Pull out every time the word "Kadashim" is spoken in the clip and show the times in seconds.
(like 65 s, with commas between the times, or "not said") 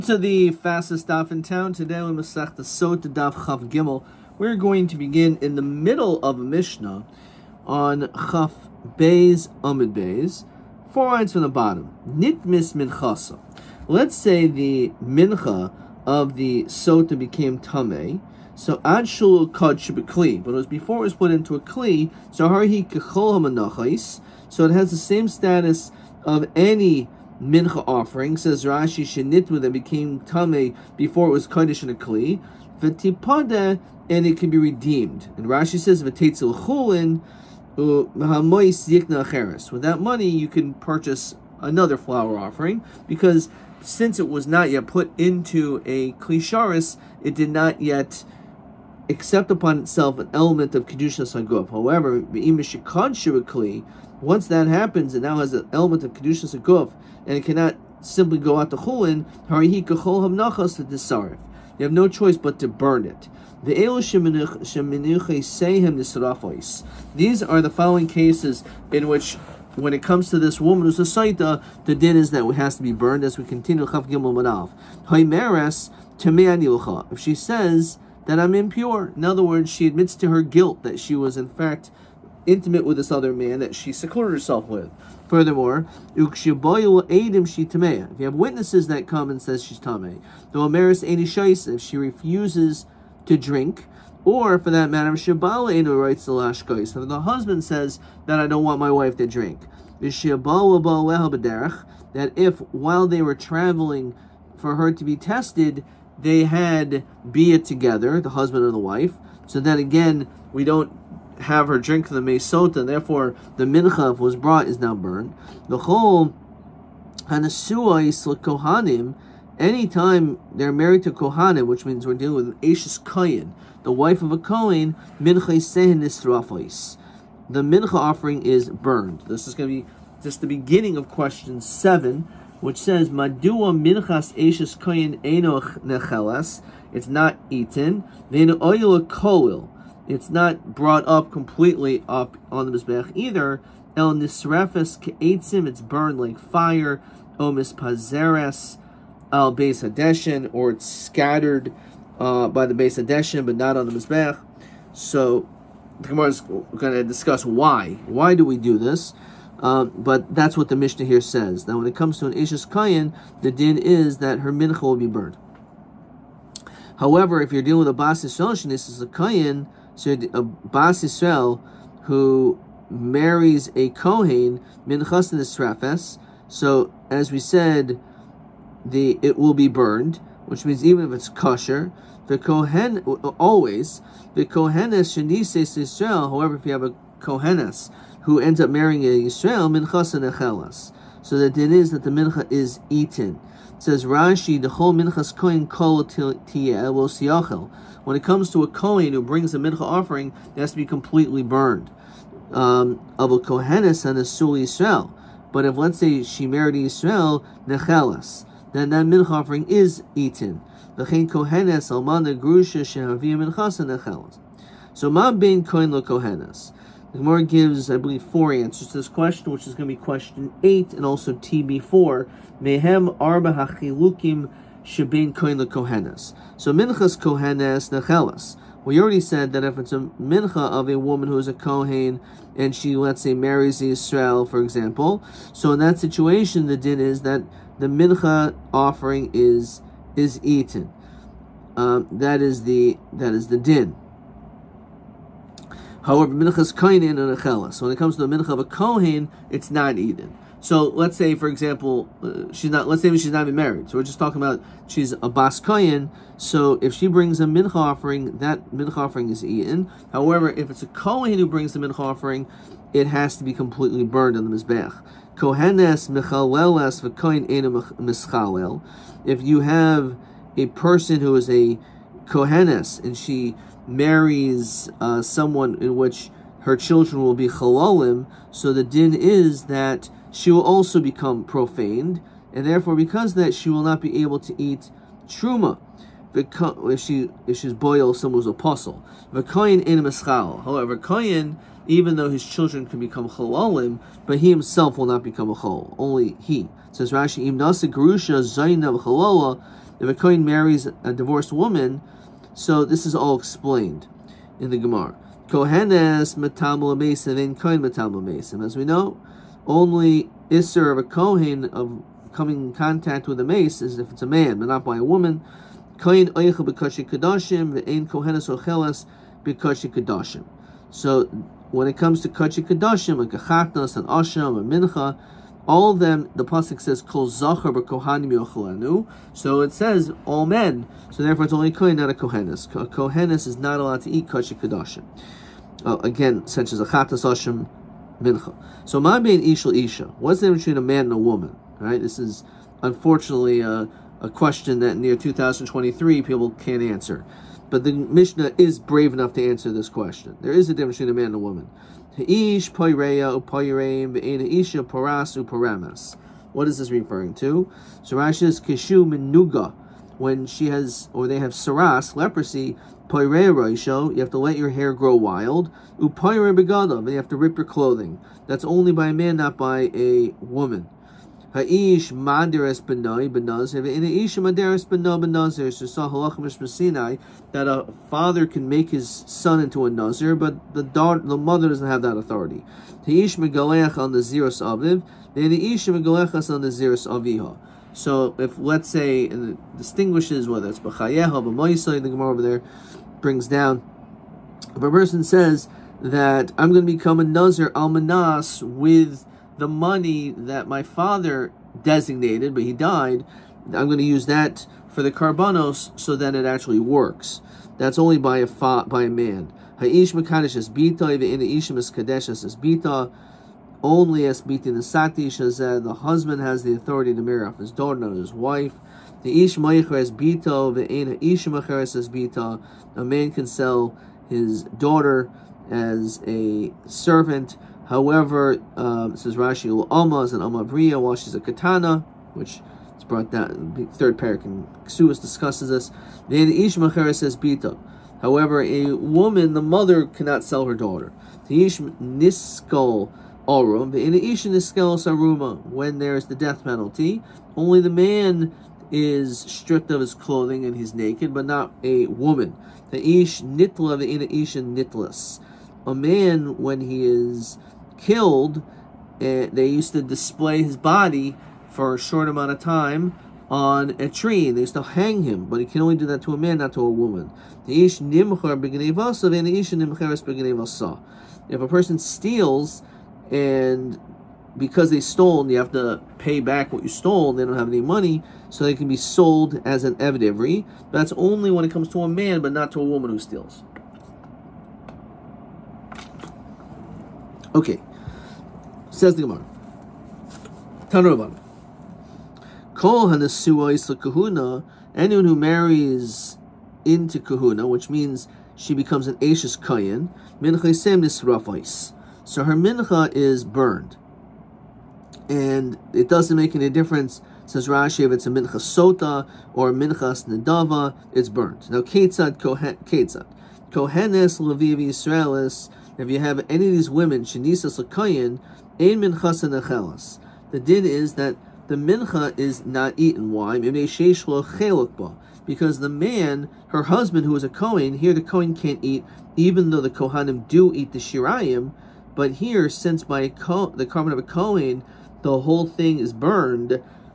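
322 s, 334 s.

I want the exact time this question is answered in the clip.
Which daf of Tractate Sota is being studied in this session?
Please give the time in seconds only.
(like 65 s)
3 s.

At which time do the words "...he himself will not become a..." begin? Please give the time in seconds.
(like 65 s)
294 s.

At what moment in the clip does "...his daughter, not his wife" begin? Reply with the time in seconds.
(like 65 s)
417 s.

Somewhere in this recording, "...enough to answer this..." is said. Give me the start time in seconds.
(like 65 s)
349 s.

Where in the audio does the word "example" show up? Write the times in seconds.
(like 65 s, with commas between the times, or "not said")
234 s, 251 s.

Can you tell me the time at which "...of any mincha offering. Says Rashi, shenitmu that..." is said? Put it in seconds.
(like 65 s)
26 s.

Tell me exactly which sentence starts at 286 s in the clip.
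If she if she's boil someone's apostle, v'koyin in mischal.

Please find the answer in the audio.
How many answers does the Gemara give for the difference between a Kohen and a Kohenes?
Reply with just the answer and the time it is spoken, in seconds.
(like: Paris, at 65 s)
4, at 218 s.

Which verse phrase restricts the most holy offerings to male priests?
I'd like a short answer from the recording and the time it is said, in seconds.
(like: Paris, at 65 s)
Kol Zachar b'Kohanim Yochelanu, at 327 s.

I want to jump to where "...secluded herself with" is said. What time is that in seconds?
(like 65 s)
83 s.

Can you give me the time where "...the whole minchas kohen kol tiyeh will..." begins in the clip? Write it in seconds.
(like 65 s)
194 s.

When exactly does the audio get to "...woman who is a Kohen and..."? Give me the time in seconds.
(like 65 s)
230 s.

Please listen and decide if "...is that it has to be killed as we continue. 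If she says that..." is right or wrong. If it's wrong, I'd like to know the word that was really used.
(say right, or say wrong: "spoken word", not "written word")
wrong: "burned", not "killed".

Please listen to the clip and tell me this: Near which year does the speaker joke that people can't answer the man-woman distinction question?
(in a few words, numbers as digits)
2023.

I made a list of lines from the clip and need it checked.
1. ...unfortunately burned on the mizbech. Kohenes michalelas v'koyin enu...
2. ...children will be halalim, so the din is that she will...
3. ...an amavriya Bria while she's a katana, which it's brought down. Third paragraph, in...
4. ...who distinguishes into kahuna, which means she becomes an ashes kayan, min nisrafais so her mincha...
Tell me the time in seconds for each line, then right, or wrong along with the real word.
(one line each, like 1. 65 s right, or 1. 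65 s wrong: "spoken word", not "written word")
1. 263 s wrong: "completely", not "unfortunately"
2. 276 s right
3. 430 s right
4. 495 s wrong: "marries", not "distinguishes".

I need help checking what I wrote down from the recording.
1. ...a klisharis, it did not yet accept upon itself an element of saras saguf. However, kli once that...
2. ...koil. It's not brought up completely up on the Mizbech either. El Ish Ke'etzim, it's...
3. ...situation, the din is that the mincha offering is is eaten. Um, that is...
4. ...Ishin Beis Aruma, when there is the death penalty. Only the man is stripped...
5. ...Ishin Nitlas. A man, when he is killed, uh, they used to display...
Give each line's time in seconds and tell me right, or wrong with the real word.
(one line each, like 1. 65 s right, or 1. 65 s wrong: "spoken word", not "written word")
1. 45 s wrong: "kedushas", not "saras"
2. 139 s wrong: "Nisrefes", not "Ish"
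3. 235 s right
4. 444 s wrong: "Iskelos", not "Beis"
5. 454 s right.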